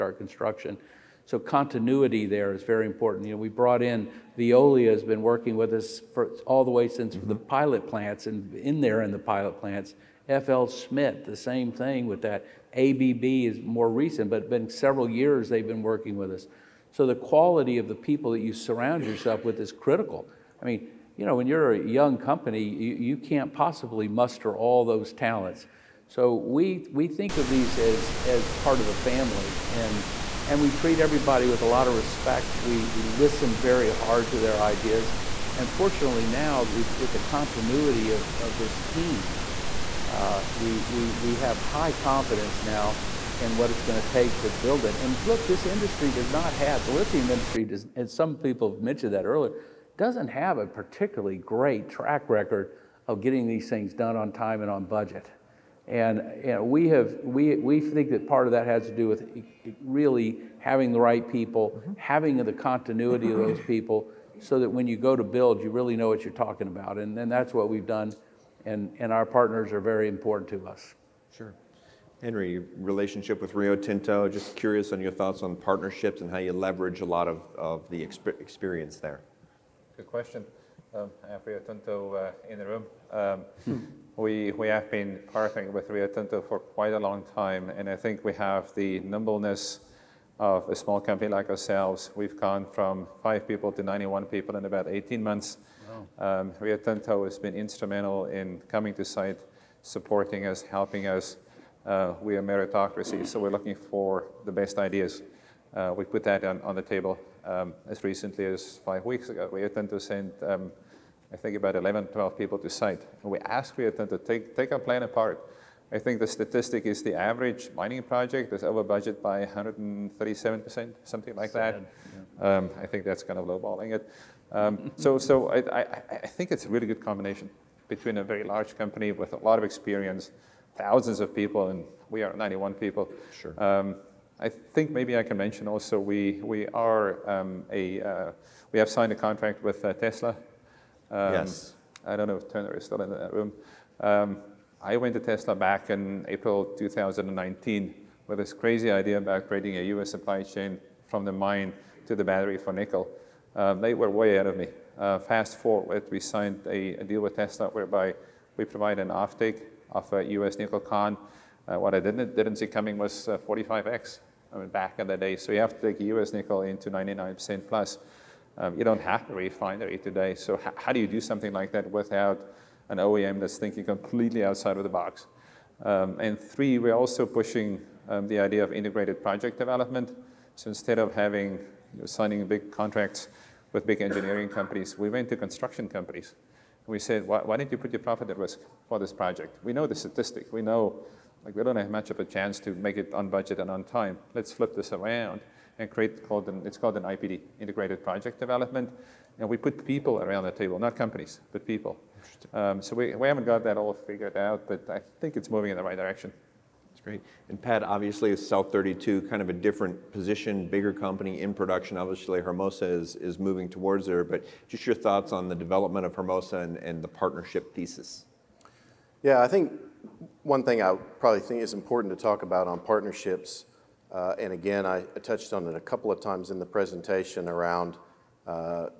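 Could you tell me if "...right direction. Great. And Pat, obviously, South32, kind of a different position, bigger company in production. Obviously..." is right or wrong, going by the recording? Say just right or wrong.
right.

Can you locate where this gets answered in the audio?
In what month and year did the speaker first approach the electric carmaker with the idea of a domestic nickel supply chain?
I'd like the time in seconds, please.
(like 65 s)
146 s.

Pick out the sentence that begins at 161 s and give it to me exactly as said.
Uh, what I didn't, didn't see coming was 45x.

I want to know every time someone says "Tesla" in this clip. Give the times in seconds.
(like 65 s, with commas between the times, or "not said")
139 s, 145 s, 157 s.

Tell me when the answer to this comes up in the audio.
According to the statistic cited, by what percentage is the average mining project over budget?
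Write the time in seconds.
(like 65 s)
119 s.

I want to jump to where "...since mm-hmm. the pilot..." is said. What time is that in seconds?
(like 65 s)
6 s.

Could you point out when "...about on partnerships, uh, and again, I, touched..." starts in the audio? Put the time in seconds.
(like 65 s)
222 s.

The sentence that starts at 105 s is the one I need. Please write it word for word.
Uh, we put that on, on the table um, as recently as five weeks ago.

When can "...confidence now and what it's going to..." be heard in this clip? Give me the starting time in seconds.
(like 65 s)
41 s.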